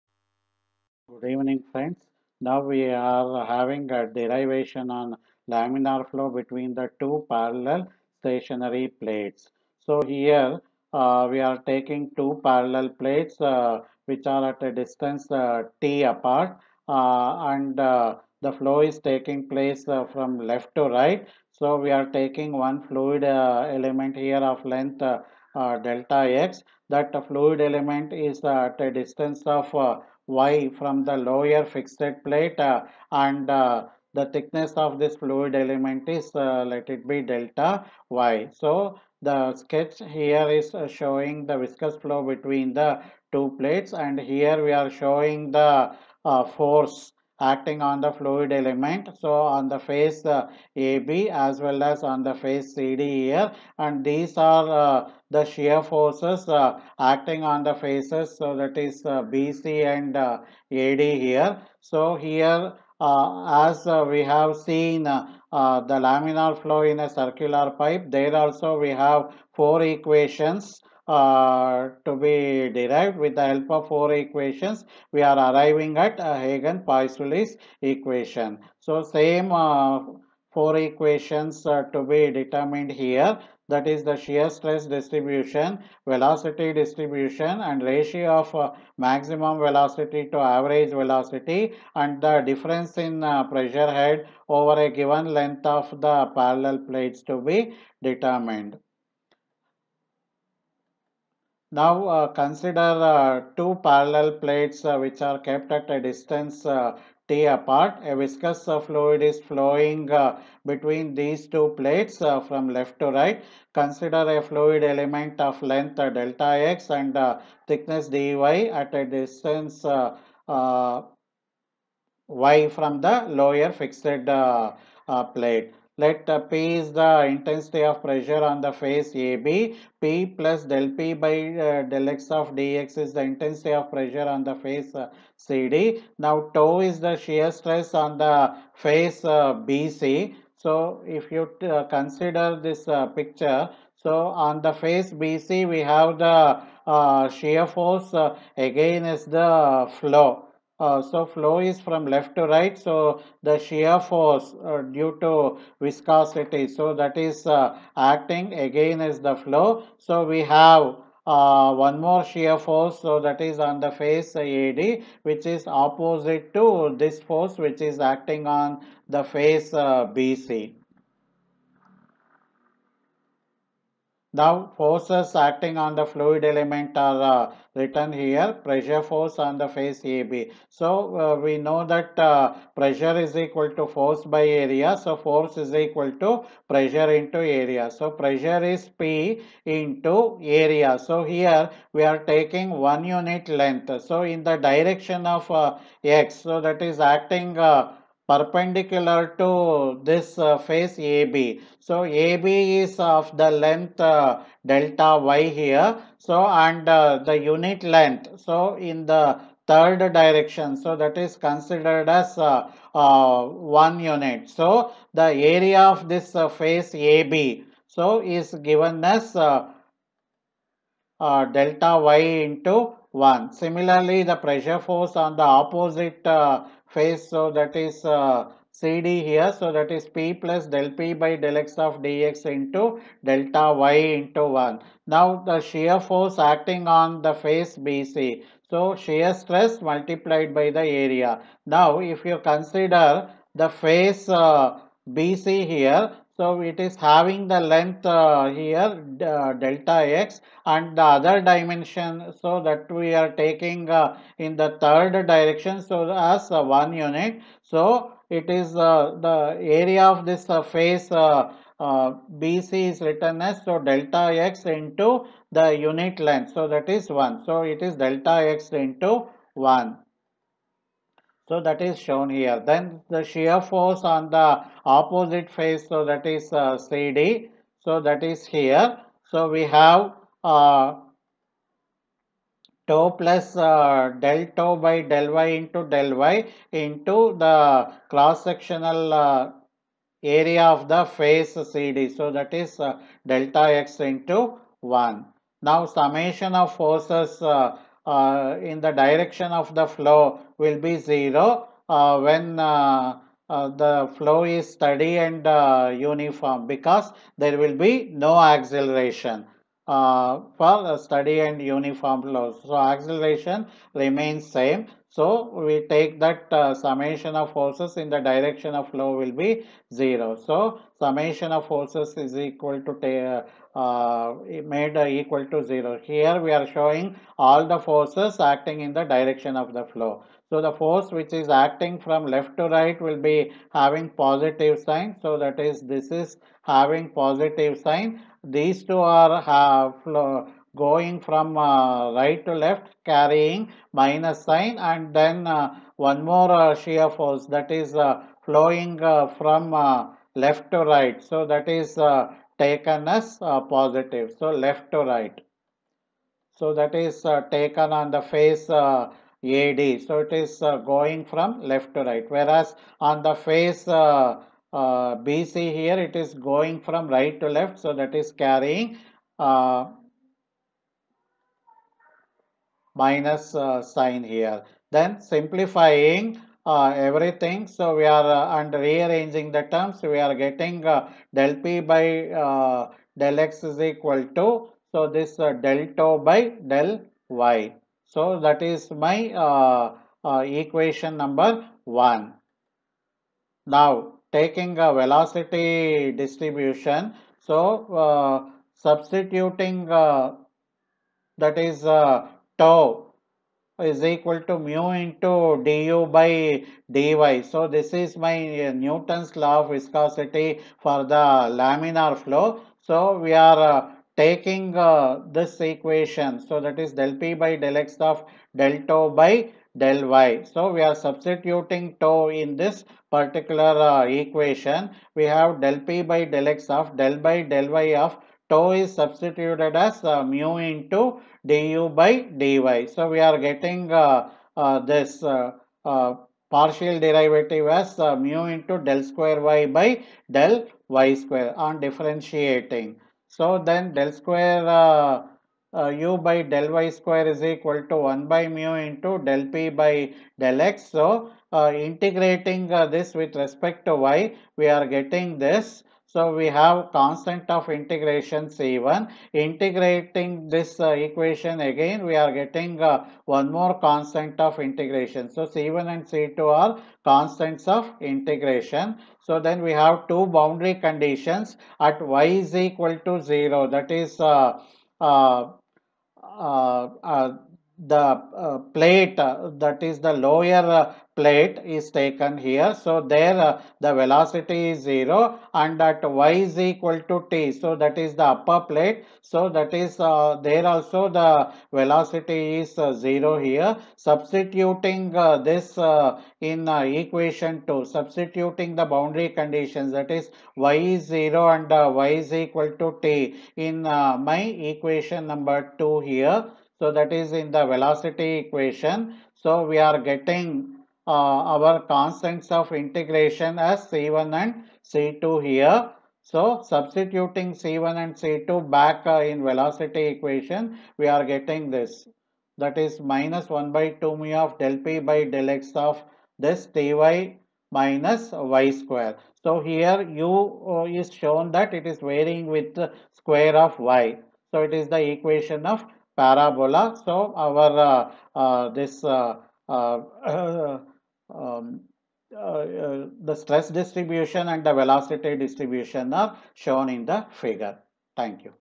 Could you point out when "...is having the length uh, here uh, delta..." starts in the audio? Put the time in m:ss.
4:06.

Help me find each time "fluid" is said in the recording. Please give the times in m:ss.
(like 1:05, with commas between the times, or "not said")
0:22, 0:27, 0:35, 0:48, 1:48, 1:54, 2:56.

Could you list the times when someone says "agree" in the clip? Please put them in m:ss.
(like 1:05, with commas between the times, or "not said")
not said.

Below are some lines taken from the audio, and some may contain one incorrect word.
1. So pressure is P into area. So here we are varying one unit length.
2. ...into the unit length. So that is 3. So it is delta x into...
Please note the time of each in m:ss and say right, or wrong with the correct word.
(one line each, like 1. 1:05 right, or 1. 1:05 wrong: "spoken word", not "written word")
1. 3:07 wrong: "taking", not "varying"
2. 4:24 wrong: "1", not "3".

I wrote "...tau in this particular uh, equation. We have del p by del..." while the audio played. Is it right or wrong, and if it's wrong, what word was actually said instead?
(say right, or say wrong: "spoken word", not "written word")
right.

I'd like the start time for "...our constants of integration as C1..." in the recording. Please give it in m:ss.
8:31.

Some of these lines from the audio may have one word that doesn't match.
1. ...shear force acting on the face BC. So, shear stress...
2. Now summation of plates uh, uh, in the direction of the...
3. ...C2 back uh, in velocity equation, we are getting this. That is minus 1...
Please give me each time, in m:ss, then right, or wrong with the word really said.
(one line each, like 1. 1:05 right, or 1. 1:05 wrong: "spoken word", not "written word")
1. 3:55 right
2. 4:55 wrong: "forces", not "plates"
3. 8:38 right.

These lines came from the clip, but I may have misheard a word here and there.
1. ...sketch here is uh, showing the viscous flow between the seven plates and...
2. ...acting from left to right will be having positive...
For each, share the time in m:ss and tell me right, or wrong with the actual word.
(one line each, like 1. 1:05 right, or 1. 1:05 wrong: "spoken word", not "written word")
1. 0:39 wrong: "two", not "seven"
2. 5:31 right.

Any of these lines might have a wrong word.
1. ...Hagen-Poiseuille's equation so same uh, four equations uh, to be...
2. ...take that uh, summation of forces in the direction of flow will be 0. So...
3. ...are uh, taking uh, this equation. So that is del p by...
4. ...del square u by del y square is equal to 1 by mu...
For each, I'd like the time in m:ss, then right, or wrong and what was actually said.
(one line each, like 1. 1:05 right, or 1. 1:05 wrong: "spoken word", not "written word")
1. 1:16 right
2. 5:15 right
3. 6:53 right
4. 7:23 right.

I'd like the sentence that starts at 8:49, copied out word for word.
So here u uh, is shown that it is varying with the square of y.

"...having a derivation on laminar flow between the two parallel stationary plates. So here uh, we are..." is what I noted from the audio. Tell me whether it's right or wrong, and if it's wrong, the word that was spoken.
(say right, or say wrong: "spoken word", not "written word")
right.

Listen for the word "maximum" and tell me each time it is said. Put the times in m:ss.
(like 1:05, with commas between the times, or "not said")
1:28.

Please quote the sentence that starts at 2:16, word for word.
Now tau is the shear stress on the face uh, BC.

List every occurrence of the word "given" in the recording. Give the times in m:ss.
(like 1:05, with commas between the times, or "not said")
1:34, 3:38.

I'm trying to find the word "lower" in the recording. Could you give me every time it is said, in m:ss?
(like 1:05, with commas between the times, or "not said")
0:31, 2:03, 8:00.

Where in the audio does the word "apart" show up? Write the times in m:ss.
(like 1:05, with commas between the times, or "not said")
0:16, 1:47.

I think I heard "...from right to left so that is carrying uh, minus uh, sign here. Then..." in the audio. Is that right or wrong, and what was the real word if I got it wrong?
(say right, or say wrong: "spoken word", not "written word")
right.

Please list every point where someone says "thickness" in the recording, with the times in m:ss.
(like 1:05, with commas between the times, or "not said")
0:34, 1:57.